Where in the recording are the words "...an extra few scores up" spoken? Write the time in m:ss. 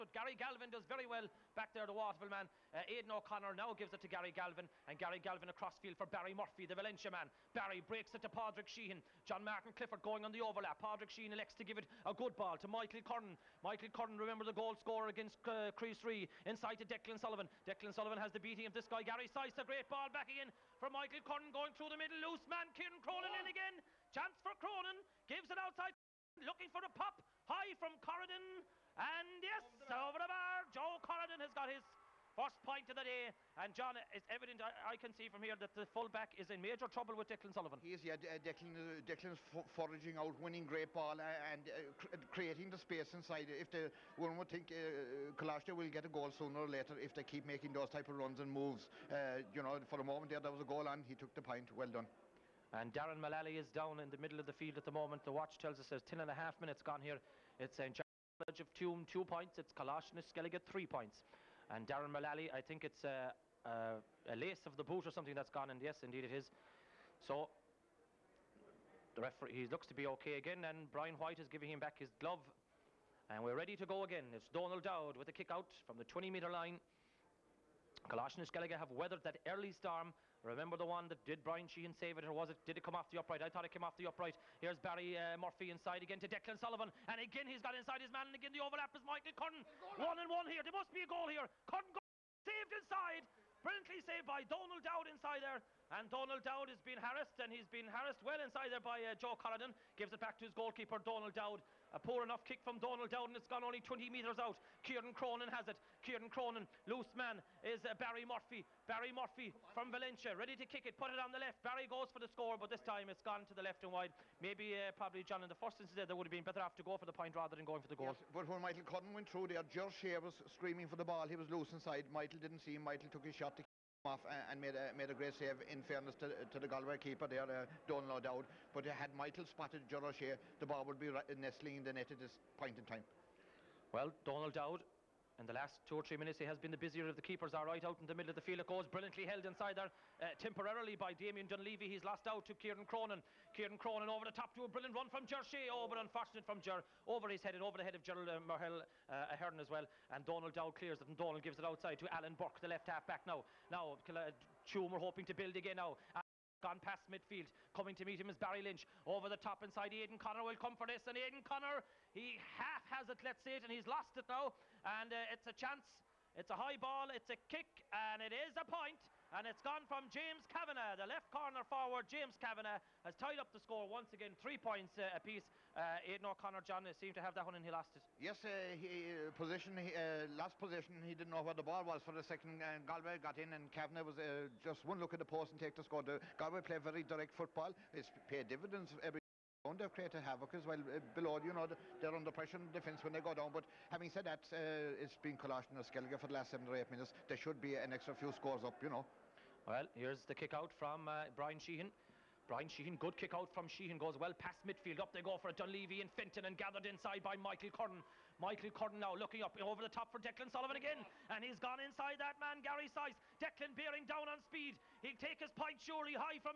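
3:17.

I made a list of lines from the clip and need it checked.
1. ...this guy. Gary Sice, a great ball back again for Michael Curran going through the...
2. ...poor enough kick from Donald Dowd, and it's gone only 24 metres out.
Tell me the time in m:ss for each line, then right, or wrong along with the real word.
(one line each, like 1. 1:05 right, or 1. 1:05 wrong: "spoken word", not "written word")
1. 0:18 right
2. 1:41 wrong: "20", not "24".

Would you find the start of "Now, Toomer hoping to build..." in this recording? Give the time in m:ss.
2:33.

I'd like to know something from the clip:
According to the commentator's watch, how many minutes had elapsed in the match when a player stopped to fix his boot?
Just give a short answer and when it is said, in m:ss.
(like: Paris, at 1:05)
10 and a half, at 0:56.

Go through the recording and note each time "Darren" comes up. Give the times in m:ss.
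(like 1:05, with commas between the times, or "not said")
0:52, 1:01.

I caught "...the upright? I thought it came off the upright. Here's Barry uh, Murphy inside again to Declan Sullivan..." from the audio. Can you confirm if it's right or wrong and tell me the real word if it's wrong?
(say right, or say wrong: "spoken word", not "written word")
right.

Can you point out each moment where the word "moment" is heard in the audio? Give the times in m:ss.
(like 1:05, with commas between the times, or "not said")
0:50, 0:54.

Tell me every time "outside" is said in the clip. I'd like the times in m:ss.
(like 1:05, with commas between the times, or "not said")
0:25, 2:31.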